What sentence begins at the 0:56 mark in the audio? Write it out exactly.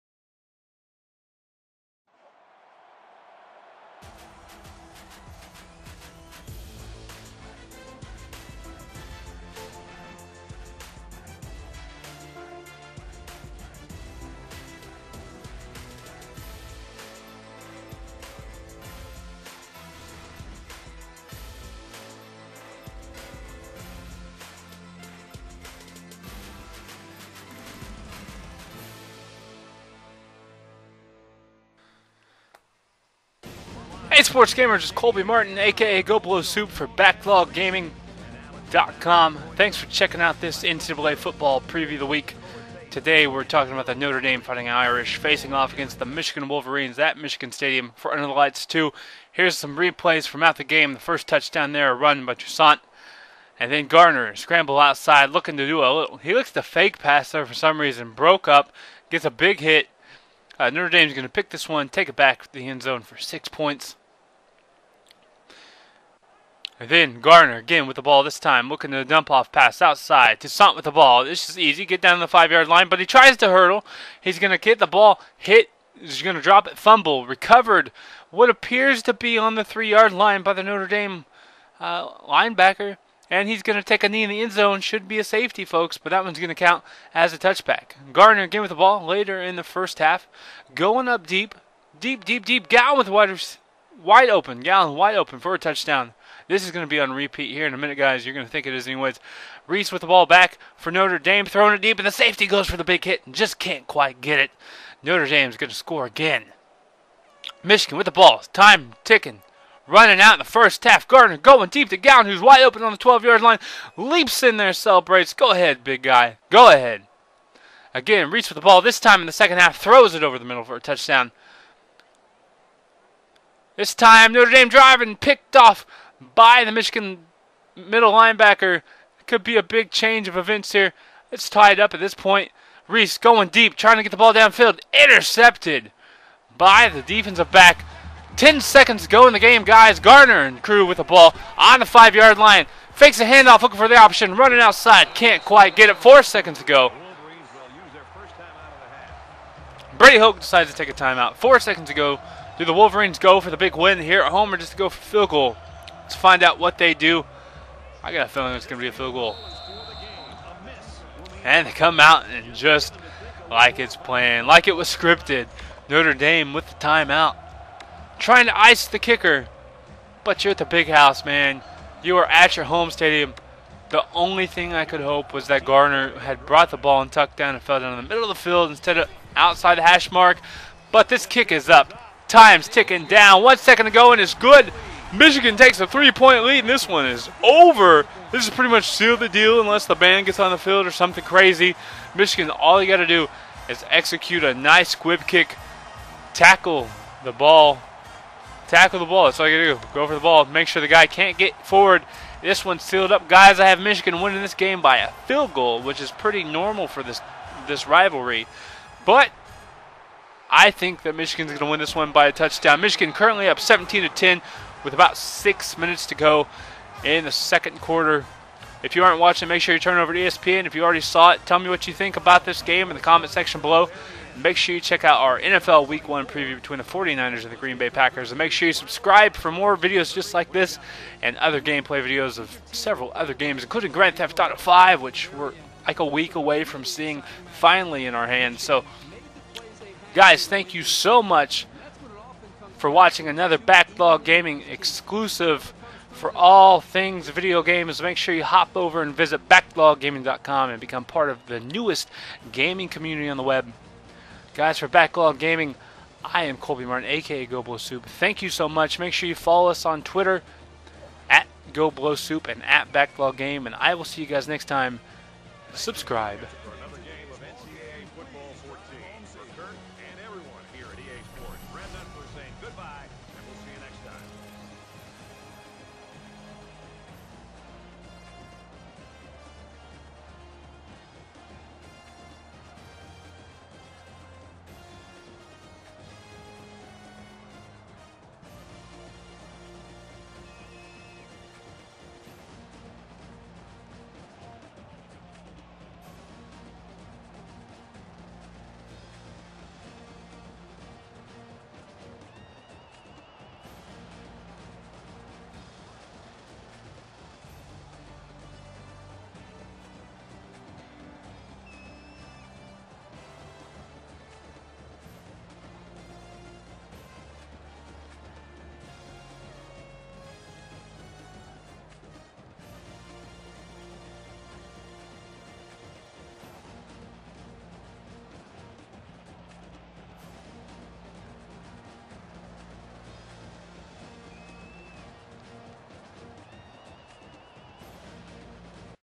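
He looks to fake pass there for some reason, broke up, gets a big hit.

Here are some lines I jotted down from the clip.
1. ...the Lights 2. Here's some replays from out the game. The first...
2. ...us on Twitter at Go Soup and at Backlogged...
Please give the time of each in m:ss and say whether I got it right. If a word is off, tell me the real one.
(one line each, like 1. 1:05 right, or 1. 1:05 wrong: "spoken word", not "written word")
1. 0:48 right
2. 4:19 right.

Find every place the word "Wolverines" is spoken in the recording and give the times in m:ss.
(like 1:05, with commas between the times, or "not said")
0:46, 2:32.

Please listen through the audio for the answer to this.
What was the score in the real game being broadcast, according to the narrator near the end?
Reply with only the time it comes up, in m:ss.
3:33.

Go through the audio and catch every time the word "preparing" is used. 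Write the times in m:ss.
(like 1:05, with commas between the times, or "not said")
not said.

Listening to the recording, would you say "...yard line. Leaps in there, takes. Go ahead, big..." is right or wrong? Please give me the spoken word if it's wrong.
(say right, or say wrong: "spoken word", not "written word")
wrong: "celebrates", not "takes".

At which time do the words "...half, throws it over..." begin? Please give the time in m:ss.
1:59.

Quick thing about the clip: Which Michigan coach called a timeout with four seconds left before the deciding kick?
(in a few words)
Brady Hoke.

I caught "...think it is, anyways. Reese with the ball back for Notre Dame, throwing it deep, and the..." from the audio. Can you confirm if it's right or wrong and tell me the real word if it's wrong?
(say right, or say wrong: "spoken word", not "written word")
right.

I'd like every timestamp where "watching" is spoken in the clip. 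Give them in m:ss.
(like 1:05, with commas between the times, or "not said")
3:39, 4:02.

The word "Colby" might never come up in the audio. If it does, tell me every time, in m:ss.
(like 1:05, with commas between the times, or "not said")
0:34, 4:16.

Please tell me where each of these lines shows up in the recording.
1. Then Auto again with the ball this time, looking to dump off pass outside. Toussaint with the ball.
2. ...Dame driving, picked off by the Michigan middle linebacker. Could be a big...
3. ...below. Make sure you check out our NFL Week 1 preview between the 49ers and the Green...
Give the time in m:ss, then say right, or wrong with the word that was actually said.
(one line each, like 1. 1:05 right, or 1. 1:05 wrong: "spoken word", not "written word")
1. 1:06 wrong: "Gardner", not "Auto"
2. 2:04 right
3. 3:43 right.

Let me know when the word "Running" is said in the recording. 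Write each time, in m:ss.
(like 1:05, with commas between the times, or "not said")
1:49, 2:24.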